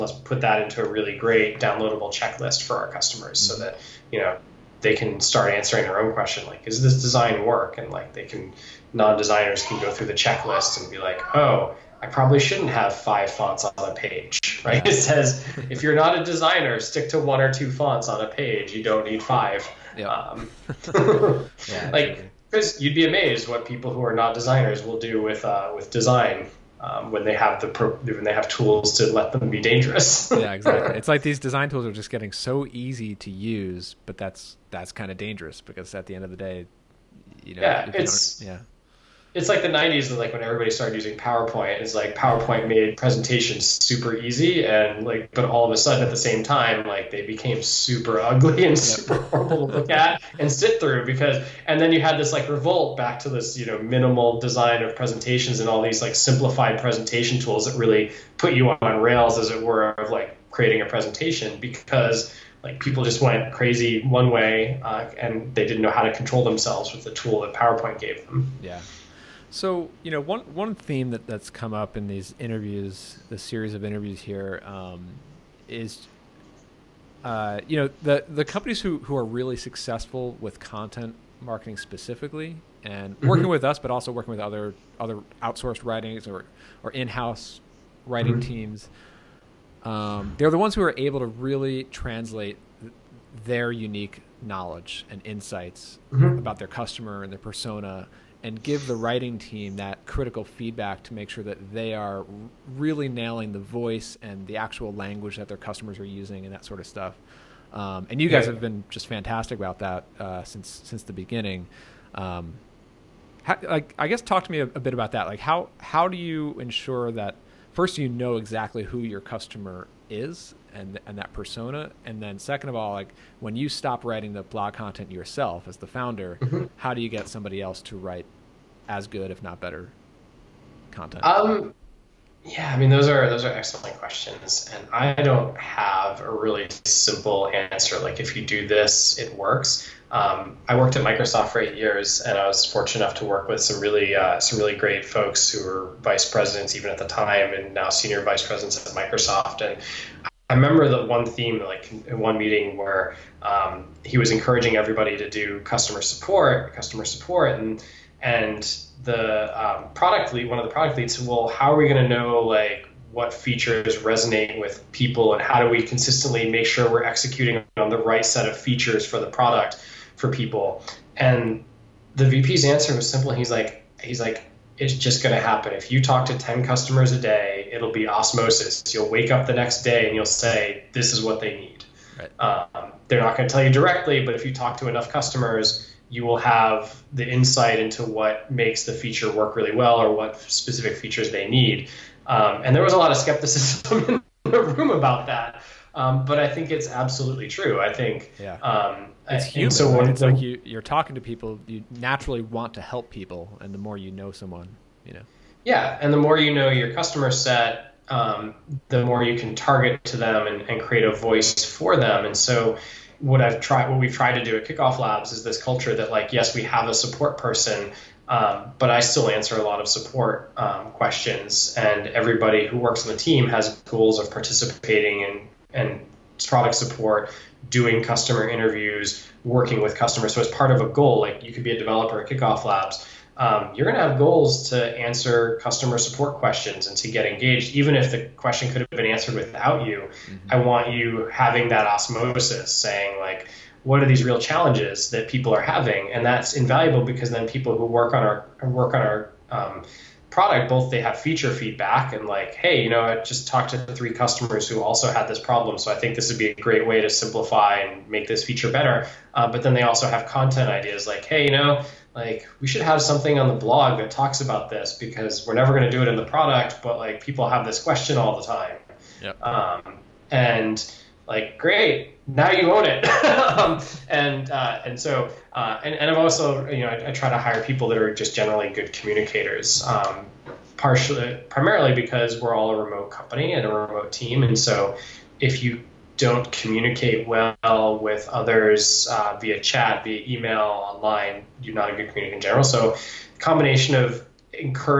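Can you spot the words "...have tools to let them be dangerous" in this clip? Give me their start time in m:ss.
0:28.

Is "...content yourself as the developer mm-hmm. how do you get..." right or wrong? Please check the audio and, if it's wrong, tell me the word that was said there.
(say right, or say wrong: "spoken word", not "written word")
wrong: "founder", not "developer".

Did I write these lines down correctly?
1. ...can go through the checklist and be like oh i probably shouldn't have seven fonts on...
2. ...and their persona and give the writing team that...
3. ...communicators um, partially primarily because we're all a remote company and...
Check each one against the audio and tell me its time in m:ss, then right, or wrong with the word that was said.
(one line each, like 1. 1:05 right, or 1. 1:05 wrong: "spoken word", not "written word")
1. 0:09 wrong: "five", not "seven"
2. 1:37 right
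3. 4:38 right.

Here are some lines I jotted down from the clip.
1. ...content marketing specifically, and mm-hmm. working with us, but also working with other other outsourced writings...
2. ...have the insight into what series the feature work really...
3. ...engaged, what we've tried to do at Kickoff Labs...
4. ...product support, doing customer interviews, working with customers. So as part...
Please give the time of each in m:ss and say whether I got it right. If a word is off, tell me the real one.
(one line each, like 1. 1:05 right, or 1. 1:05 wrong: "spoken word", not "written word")
1. 1:20 right
2. 3:06 wrong: "makes", not "series"
3. 3:33 wrong: "tried", not "engaged"
4. 3:46 right.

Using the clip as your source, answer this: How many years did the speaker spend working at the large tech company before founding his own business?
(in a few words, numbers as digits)
8.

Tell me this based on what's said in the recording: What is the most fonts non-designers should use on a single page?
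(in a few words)
one or two.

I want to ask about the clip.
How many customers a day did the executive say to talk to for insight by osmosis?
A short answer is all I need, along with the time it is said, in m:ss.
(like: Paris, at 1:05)
10, at 2:56.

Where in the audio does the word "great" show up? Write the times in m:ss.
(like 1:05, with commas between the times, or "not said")
0:01, 2:24, 4:16, 4:31.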